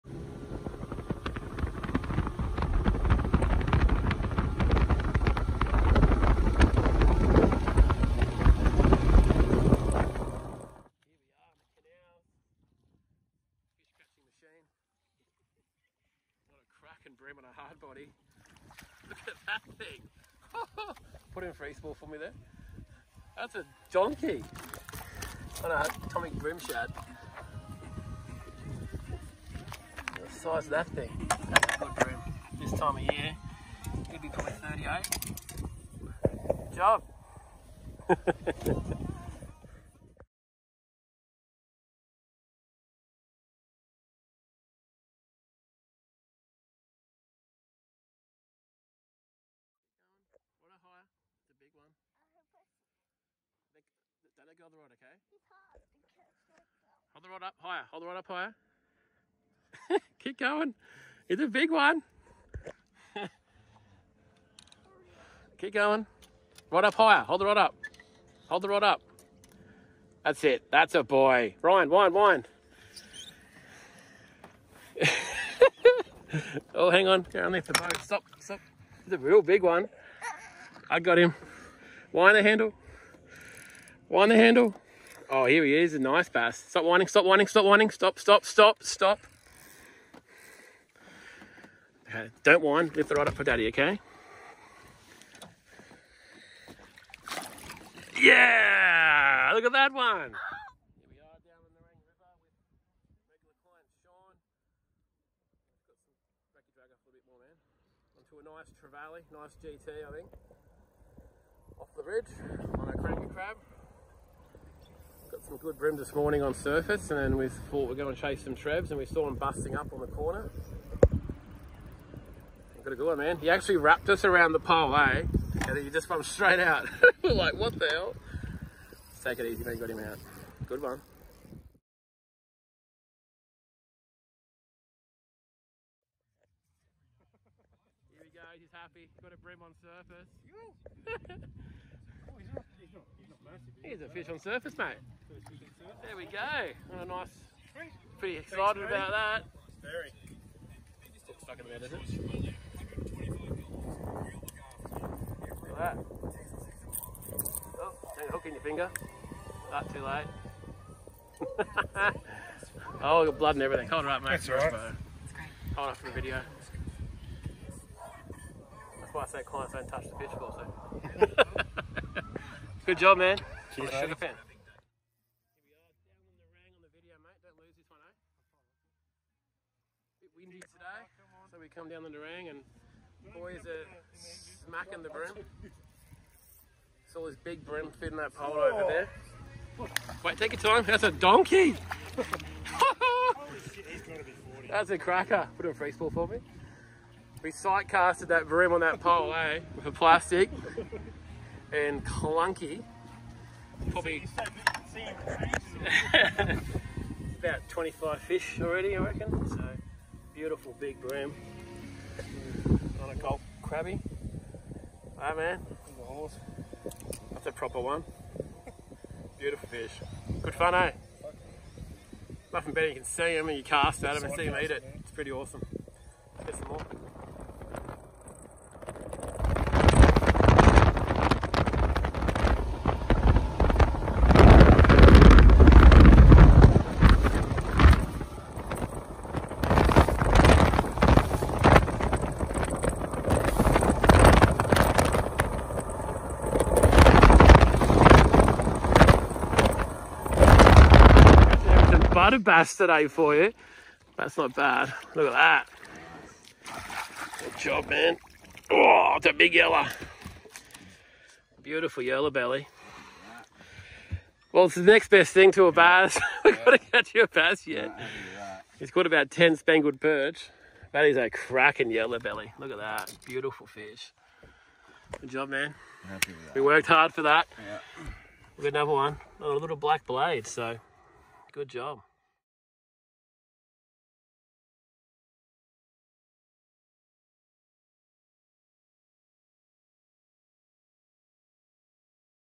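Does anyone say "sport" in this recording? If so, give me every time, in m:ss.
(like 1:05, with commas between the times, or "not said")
3:15.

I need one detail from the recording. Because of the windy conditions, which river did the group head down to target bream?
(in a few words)
Nerang.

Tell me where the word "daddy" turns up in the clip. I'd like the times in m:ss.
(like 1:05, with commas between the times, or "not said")
1:33.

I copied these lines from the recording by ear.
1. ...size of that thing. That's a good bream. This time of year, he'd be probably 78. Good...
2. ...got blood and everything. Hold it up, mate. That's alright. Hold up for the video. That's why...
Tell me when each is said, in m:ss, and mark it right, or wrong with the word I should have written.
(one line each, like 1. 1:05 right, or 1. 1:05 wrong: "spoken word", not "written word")
1. 0:30 wrong: "38", not "78"
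2. 2:43 right.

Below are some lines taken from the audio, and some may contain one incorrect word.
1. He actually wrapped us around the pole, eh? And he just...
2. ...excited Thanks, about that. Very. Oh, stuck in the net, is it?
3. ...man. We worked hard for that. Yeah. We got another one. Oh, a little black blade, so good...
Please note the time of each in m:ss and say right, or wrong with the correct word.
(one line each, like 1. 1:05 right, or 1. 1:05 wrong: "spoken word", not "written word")
1. 2:03 right
2. 2:28 right
3. 4:35 right.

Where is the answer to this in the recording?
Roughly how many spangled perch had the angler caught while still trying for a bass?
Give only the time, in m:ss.
4:29.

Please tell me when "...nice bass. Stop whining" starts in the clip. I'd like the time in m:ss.
1:25.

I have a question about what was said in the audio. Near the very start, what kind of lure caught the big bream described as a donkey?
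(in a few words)
Tommy shad.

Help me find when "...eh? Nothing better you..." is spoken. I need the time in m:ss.
3:40.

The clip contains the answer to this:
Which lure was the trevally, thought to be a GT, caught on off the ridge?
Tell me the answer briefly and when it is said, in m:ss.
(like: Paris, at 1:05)
Cranka crab, at 1:52.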